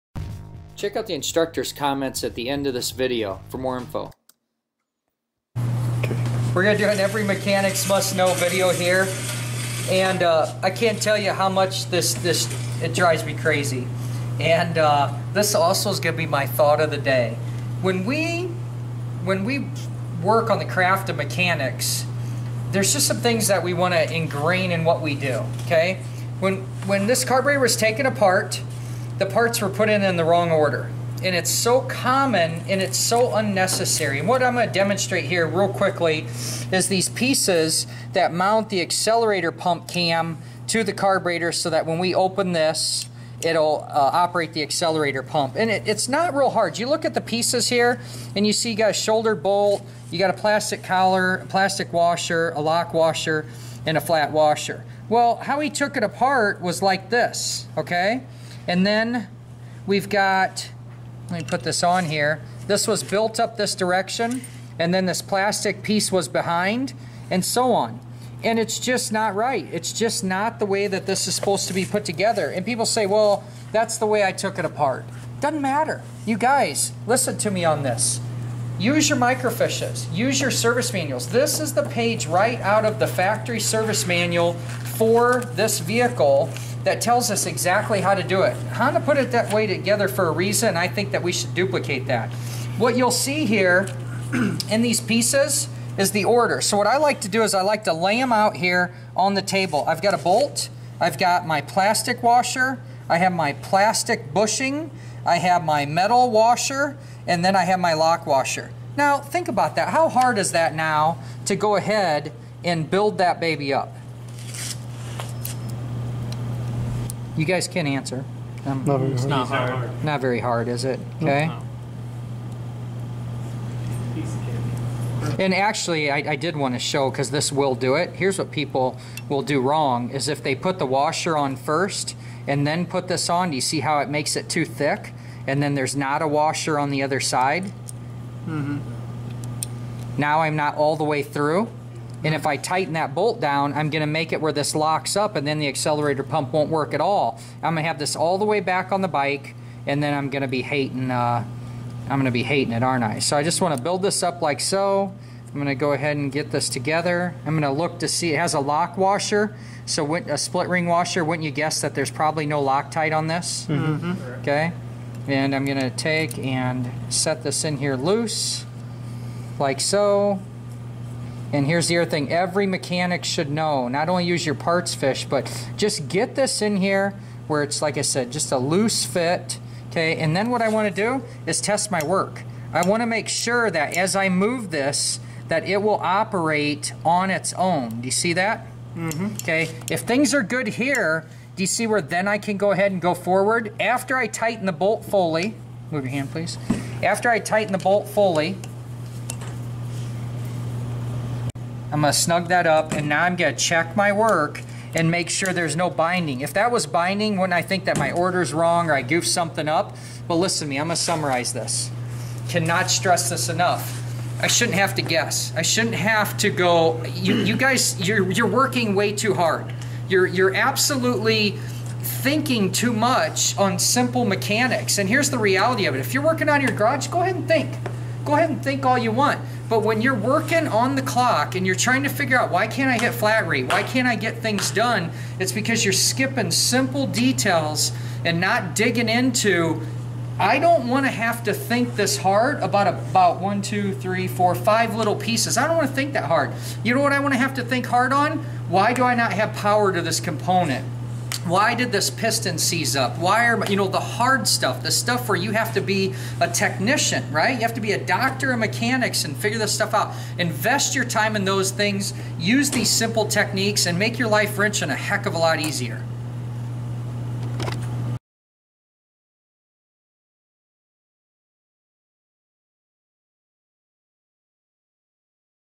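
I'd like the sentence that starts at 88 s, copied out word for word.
Honda put it that way together for a reason.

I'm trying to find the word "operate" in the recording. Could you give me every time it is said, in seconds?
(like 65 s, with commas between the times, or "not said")
44 s, 186 s.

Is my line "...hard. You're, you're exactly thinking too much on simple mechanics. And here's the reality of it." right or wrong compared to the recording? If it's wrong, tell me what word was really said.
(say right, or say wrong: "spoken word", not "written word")
wrong: "absolutely", not "exactly".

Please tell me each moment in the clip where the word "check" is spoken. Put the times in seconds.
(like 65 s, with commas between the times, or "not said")
0 s, 203 s.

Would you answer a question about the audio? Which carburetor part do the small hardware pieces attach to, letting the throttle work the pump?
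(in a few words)
accelerator pump cam.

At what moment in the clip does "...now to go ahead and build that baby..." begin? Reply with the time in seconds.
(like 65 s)
110 s.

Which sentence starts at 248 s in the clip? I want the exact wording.
Why do I not have power to this component?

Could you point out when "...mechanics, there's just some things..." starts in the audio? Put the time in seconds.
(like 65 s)
21 s.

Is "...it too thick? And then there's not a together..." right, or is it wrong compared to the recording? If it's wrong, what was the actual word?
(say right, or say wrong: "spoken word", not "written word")
wrong: "washer", not "together".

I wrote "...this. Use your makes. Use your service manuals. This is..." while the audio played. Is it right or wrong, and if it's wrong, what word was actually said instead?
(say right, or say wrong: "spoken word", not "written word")
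wrong: "microfiches", not "makes".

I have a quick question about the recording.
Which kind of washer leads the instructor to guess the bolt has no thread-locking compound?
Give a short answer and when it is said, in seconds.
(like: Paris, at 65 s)
split ring washer, at 160 s.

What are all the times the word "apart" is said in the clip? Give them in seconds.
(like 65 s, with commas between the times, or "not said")
28 s, 56 s, 74 s.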